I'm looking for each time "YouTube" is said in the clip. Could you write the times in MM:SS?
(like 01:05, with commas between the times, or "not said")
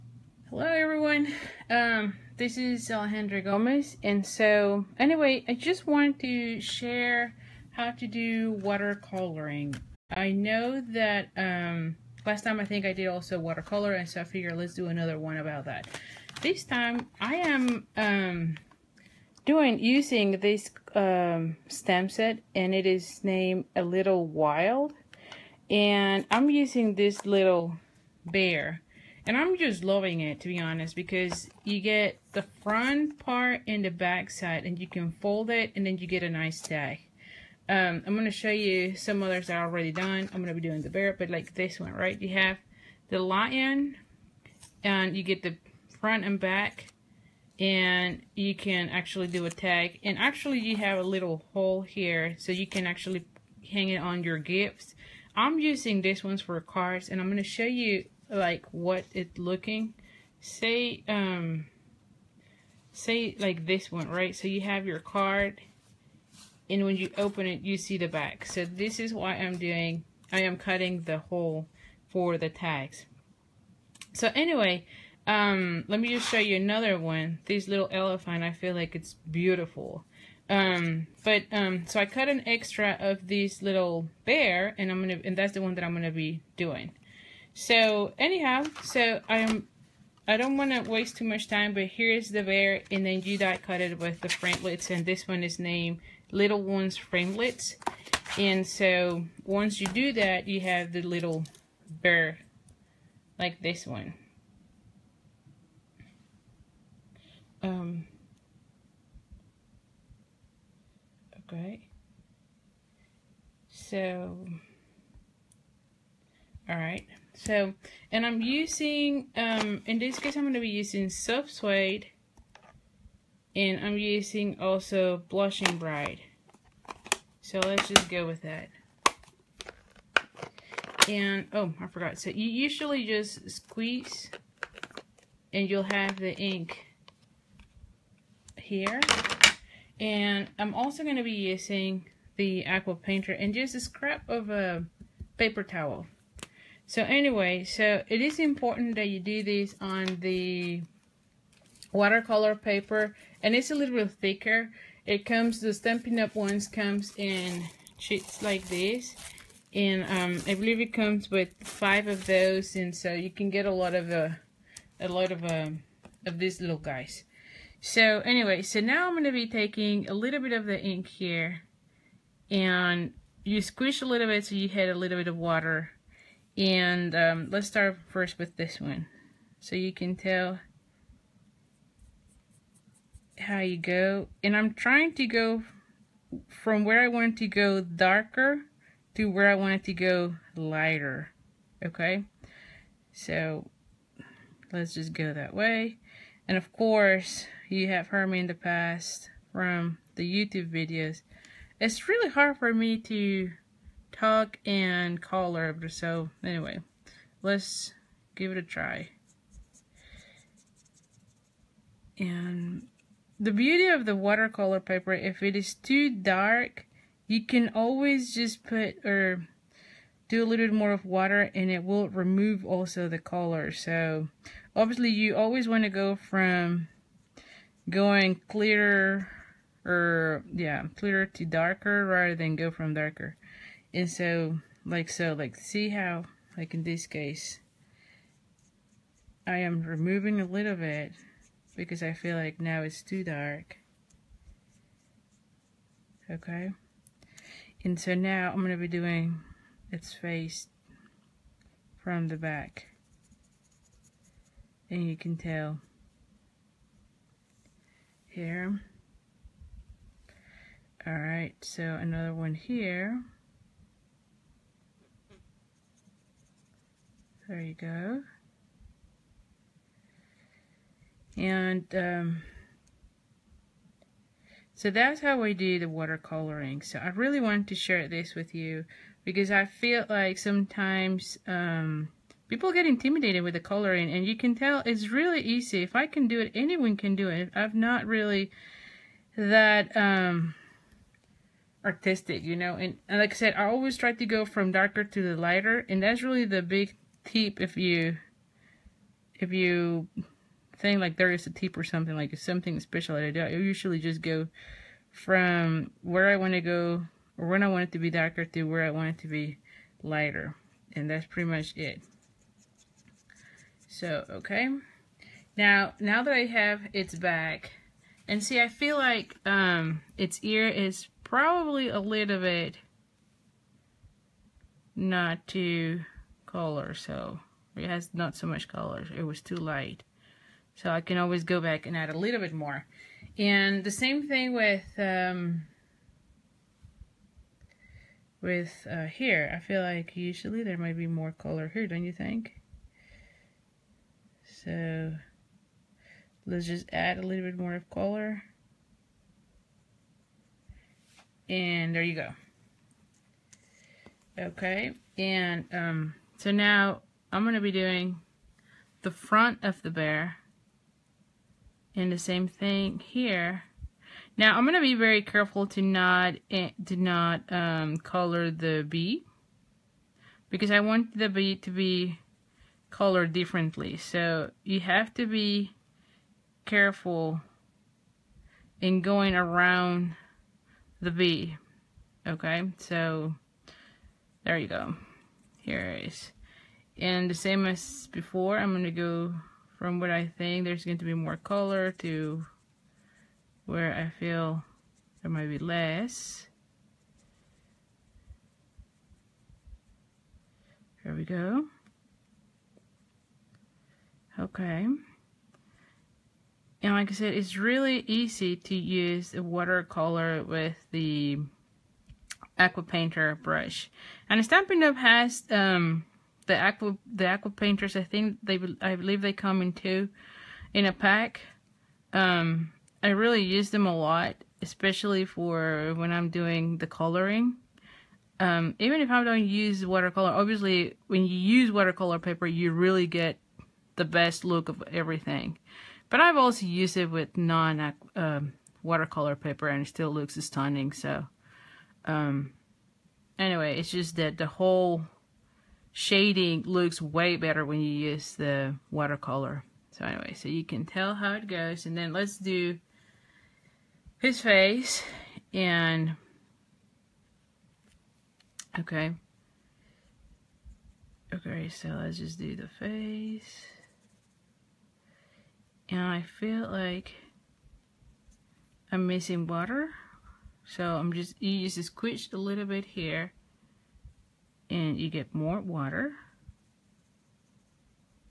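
03:20.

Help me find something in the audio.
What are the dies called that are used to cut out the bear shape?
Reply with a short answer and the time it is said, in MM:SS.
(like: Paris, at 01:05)
Little Loves Framelits, at 01:36.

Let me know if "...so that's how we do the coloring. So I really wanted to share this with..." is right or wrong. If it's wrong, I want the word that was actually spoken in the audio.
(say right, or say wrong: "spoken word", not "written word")
wrong: "watercoloring", not "coloring".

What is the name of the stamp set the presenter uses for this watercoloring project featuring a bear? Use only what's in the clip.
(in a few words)
A Little Wild.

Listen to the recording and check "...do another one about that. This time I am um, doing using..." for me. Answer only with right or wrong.
right.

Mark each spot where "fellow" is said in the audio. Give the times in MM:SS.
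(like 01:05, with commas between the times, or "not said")
not said.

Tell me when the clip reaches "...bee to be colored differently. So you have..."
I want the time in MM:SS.
06:11.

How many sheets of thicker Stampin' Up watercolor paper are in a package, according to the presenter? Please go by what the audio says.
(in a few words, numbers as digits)
5.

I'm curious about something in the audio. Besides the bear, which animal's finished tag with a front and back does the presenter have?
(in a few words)
lion.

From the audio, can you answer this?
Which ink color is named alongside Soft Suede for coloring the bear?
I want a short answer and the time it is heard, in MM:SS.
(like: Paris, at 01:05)
Blushing Bride, at 02:05.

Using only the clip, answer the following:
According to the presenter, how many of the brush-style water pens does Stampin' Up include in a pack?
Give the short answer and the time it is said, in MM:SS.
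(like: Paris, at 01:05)
2, at 06:59.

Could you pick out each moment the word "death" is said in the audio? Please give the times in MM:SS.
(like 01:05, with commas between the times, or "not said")
not said.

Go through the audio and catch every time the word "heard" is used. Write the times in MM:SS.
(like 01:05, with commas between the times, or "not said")
03:18.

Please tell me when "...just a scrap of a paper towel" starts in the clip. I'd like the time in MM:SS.
02:23.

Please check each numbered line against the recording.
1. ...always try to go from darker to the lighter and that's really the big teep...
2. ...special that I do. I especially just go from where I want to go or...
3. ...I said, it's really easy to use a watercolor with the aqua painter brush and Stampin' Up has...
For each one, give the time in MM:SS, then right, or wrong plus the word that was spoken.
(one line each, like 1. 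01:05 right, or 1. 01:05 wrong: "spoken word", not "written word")
1. 04:53 right
2. 05:02 wrong: "usually", not "especially"
3. 06:47 right.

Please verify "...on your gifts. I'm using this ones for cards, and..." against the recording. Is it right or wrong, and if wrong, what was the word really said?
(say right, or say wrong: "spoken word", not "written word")
right.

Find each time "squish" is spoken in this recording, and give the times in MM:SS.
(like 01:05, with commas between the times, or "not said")
02:53, 07:51.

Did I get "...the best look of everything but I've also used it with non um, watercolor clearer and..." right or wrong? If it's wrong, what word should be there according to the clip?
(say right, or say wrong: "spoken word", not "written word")
wrong: "paper", not "clearer".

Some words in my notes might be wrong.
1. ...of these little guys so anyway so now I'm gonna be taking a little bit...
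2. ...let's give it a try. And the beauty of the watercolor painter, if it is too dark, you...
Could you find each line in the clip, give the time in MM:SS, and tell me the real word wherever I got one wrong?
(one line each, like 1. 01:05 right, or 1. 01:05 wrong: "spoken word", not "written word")
1. 02:46 right
2. 03:27 wrong: "paper", not "painter".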